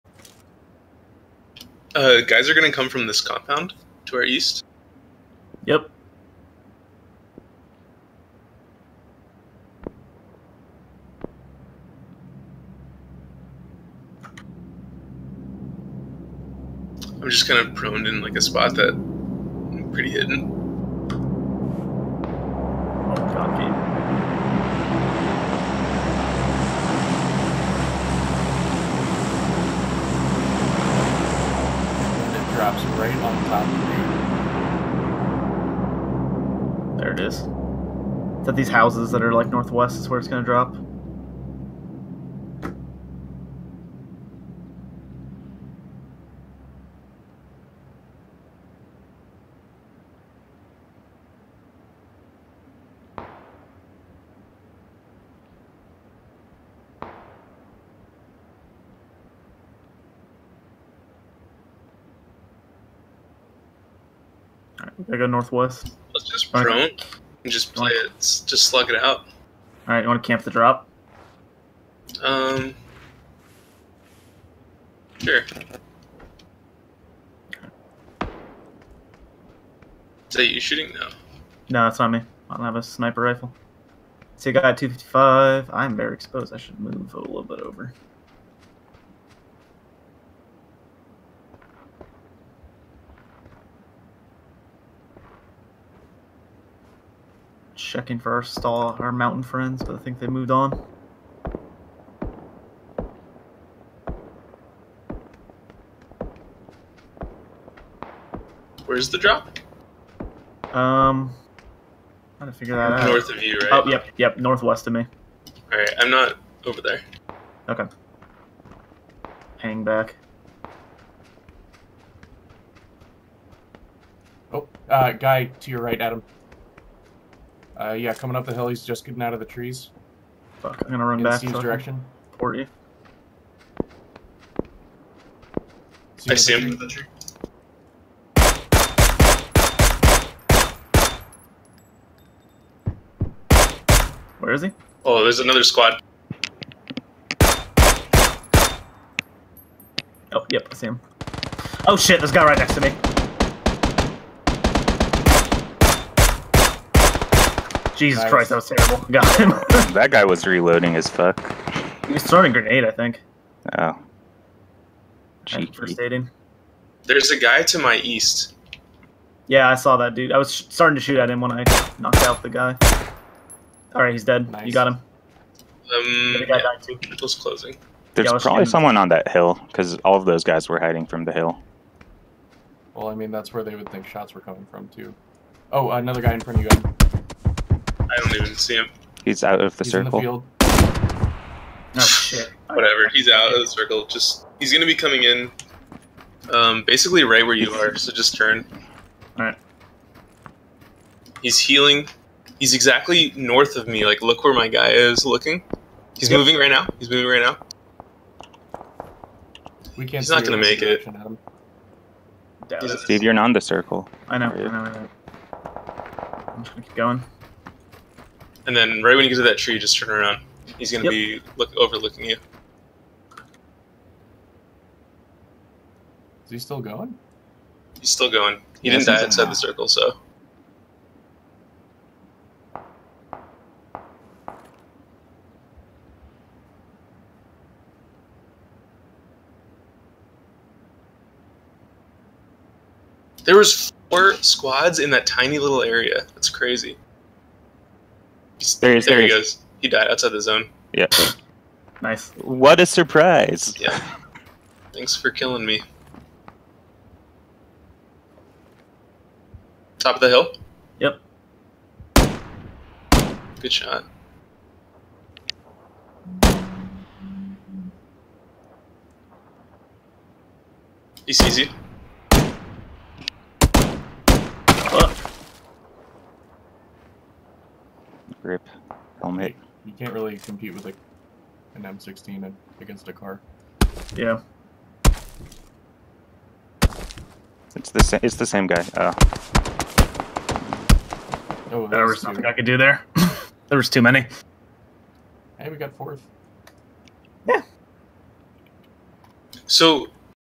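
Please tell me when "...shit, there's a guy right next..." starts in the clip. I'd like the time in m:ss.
2:31.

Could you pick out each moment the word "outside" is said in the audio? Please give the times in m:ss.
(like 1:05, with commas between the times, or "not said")
3:49, 4:10.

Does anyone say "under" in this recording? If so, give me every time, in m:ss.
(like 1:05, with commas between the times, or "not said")
not said.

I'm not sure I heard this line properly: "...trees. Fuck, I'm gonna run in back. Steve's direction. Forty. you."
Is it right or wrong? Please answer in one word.
right.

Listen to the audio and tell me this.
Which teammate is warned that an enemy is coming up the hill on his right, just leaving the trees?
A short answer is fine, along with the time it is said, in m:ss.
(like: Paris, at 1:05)
Adam, at 2:06.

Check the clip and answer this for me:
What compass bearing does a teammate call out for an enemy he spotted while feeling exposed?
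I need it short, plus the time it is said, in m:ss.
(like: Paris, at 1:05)
255, at 1:24.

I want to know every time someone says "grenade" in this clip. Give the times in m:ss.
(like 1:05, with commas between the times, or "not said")
2:42.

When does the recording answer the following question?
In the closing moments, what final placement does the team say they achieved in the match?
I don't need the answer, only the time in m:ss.
4:55.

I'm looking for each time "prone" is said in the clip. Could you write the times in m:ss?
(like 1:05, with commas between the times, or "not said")
0:17, 1:06.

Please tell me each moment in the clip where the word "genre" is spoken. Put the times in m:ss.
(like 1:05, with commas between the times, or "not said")
not said.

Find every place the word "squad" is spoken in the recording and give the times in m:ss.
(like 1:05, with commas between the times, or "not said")
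2:25, 4:04.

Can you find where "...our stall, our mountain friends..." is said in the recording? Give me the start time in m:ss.
1:38.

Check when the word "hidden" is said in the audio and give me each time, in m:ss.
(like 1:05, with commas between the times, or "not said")
0:20.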